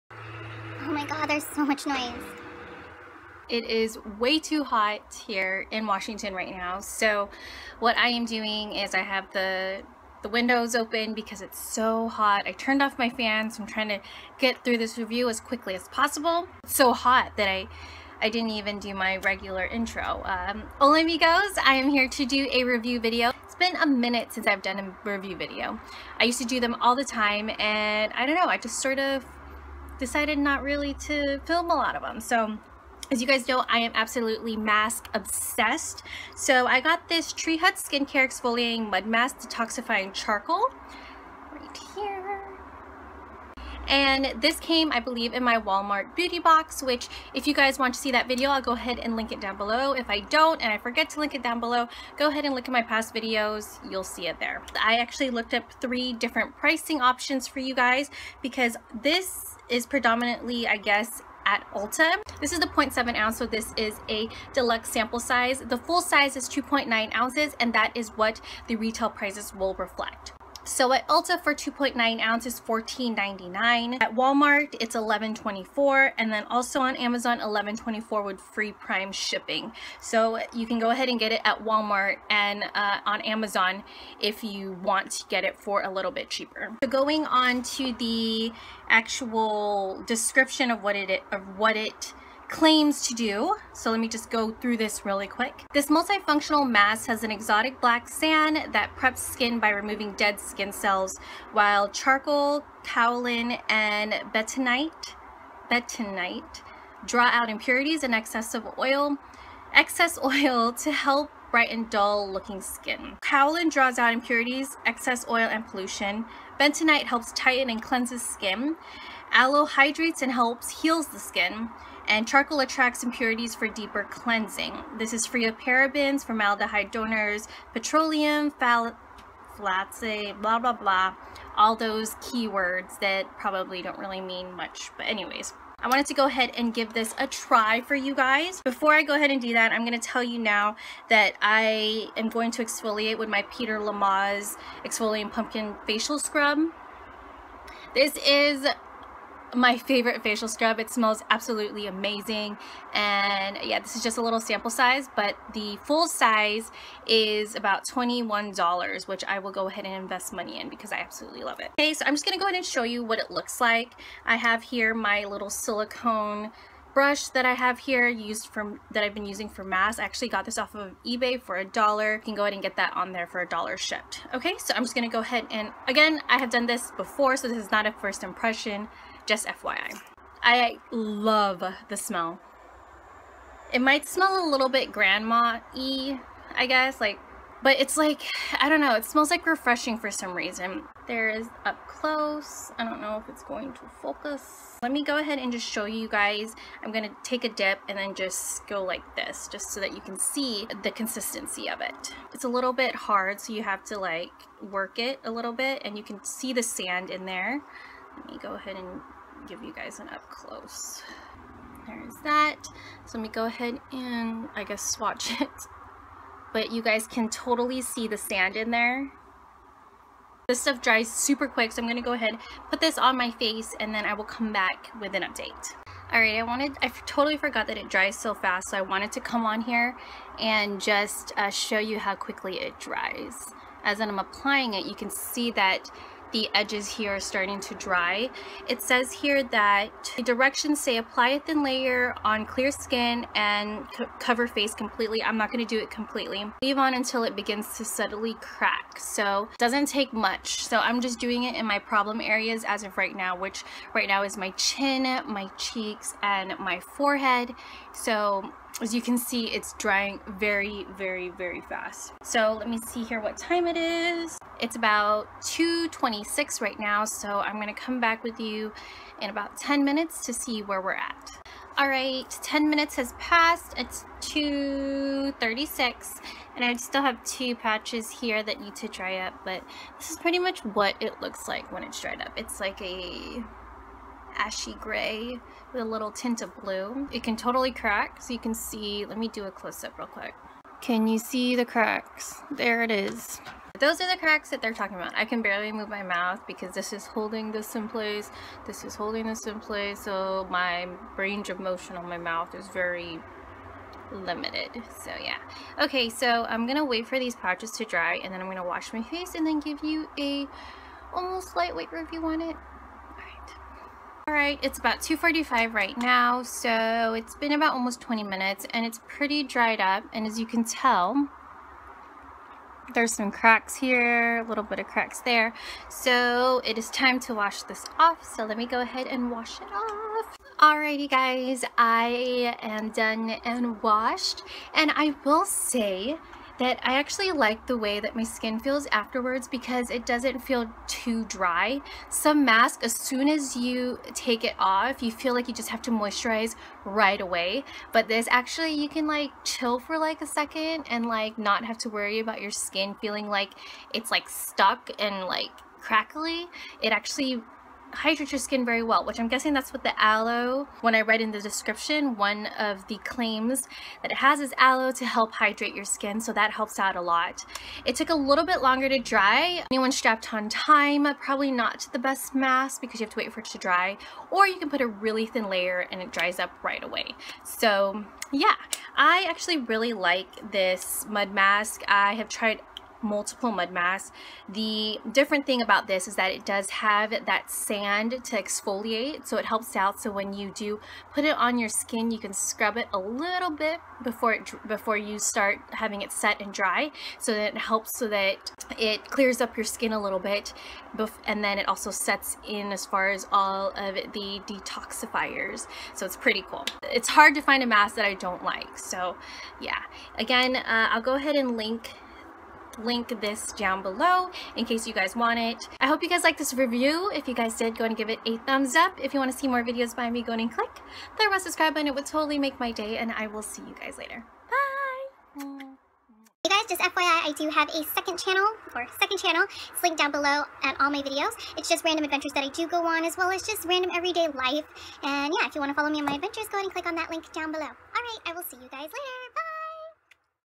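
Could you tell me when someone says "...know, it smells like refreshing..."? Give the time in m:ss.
3:08.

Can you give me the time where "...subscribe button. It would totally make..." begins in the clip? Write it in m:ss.
7:01.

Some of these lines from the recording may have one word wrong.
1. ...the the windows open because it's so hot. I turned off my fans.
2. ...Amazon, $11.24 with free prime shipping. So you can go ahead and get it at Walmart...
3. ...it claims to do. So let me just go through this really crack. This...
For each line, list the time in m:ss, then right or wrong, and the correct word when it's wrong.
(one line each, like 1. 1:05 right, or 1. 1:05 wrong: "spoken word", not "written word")
1. 0:09 right
2. 1:16 right
3. 1:31 wrong: "quick", not "crack".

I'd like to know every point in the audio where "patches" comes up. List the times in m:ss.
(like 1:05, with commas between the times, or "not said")
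4:37, 5:07.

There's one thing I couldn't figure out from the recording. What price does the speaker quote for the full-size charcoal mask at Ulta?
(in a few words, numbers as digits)
$14.99.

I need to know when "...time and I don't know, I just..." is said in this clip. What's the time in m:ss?
0:27.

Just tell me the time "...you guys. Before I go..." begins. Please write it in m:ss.
2:17.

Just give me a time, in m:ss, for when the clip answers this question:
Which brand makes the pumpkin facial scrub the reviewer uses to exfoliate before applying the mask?
2:23.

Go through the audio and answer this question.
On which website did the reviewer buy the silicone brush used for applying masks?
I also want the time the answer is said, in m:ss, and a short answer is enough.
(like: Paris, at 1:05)
eBay, at 2:51.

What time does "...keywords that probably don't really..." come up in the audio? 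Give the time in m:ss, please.
2:12.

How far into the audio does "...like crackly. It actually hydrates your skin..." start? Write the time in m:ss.
5:55.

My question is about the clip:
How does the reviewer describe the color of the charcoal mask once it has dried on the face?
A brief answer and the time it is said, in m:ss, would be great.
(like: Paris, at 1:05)
ashy gray, at 4:44.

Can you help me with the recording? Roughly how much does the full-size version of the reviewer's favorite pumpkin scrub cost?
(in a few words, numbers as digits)
$21.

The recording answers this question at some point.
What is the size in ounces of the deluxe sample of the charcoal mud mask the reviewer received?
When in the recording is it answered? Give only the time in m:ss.
1:02.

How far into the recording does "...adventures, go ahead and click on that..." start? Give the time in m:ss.
7:16.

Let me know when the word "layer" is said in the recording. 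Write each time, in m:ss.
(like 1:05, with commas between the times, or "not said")
4:01, 6:15.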